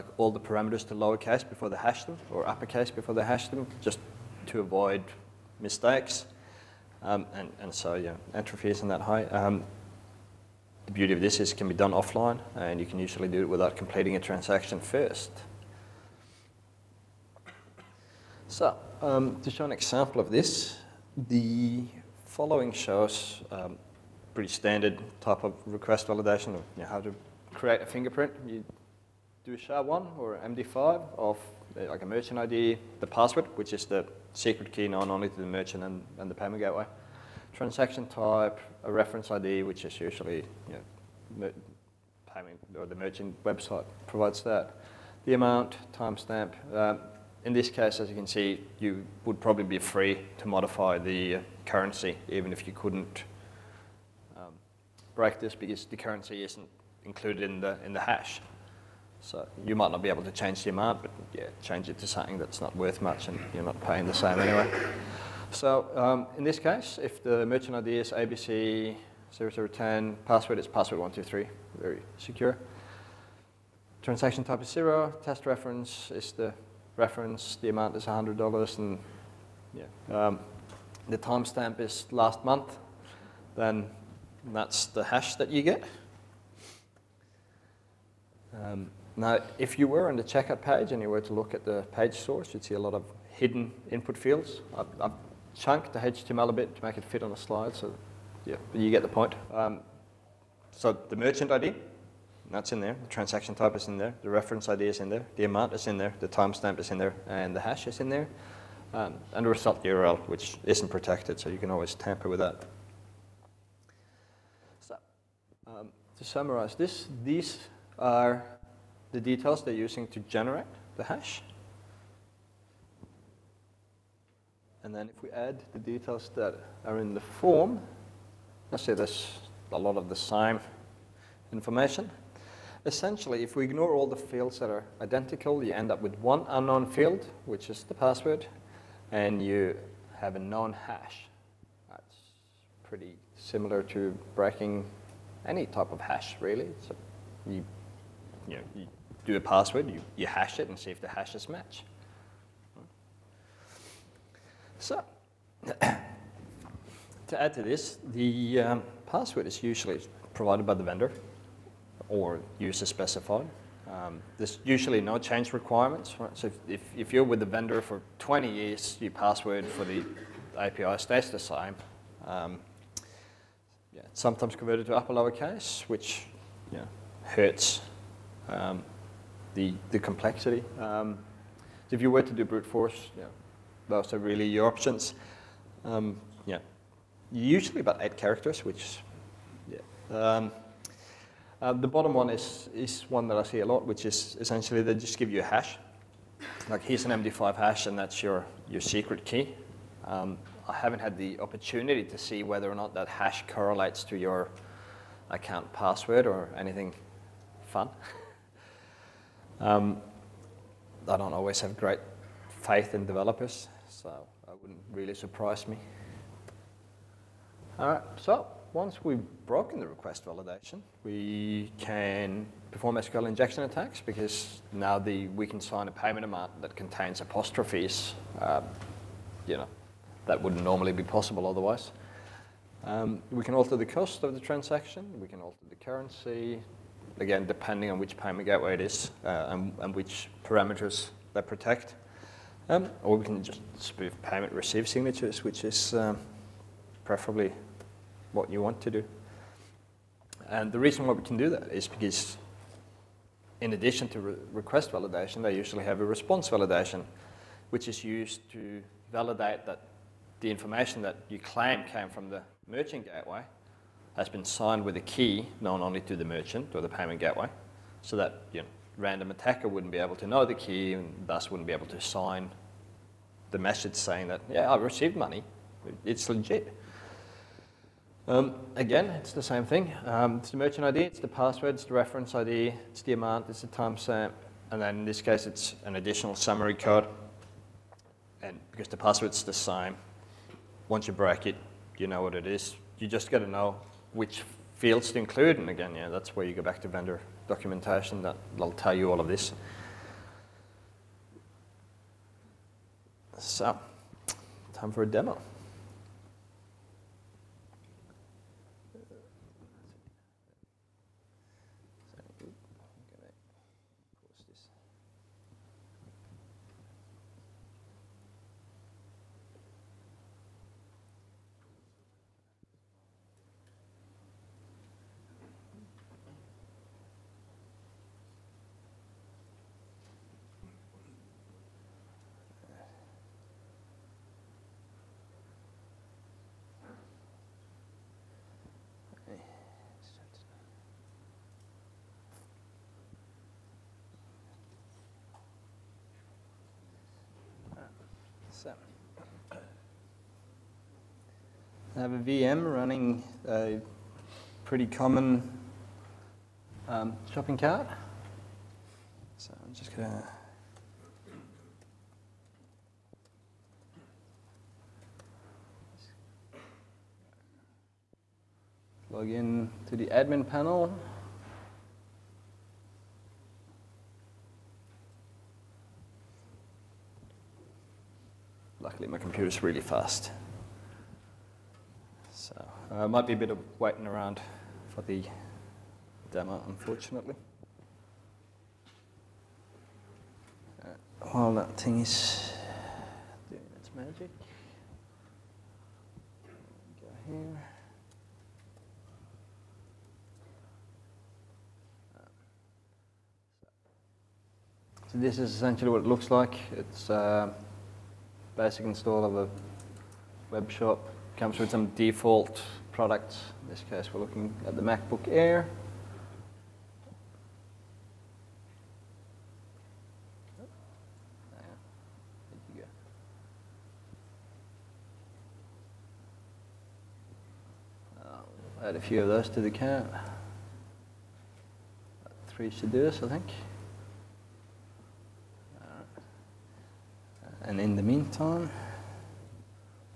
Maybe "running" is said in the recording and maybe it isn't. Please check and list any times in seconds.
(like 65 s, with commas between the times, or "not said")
352 s.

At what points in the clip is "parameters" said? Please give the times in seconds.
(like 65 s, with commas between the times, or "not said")
0 s, 240 s.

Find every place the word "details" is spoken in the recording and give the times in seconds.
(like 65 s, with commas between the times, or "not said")
119 s, 125 s.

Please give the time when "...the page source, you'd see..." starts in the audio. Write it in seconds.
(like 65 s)
91 s.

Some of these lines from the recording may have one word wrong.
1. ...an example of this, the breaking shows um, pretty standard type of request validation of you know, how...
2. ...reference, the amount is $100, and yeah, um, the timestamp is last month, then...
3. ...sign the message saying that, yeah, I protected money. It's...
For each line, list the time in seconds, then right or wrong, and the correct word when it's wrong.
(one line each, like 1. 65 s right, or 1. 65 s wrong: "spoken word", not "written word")
1. 19 s wrong: "following", not "breaking"
2. 76 s right
3. 272 s wrong: "received", not "protected".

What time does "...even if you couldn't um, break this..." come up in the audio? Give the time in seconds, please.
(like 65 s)
52 s.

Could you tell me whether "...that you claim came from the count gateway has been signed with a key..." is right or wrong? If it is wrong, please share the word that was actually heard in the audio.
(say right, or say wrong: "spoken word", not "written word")
wrong: "merchant", not "count".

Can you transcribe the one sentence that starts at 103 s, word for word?
The transaction type is in there.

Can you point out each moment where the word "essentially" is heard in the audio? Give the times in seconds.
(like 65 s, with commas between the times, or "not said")
132 s, 194 s, 405 s.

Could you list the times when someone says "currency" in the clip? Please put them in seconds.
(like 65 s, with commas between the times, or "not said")
51 s, 55 s, 235 s.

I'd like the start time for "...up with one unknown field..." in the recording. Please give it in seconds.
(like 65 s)
135 s.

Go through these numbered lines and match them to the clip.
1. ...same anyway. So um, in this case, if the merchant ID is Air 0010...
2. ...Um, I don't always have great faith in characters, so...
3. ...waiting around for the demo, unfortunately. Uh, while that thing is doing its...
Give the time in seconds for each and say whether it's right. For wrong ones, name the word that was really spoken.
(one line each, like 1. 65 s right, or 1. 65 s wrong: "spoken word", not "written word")
1. 64 s wrong: "ABC", not "Air"
2. 209 s wrong: "developers", not "characters"
3. 383 s right.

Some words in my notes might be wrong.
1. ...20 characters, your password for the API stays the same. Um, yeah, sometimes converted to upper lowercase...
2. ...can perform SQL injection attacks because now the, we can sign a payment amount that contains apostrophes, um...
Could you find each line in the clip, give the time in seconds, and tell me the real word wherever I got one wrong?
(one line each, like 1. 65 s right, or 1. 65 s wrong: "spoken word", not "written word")
1. 168 s wrong: "years", not "characters"
2. 221 s right.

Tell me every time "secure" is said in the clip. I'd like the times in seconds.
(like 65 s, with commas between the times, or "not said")
72 s.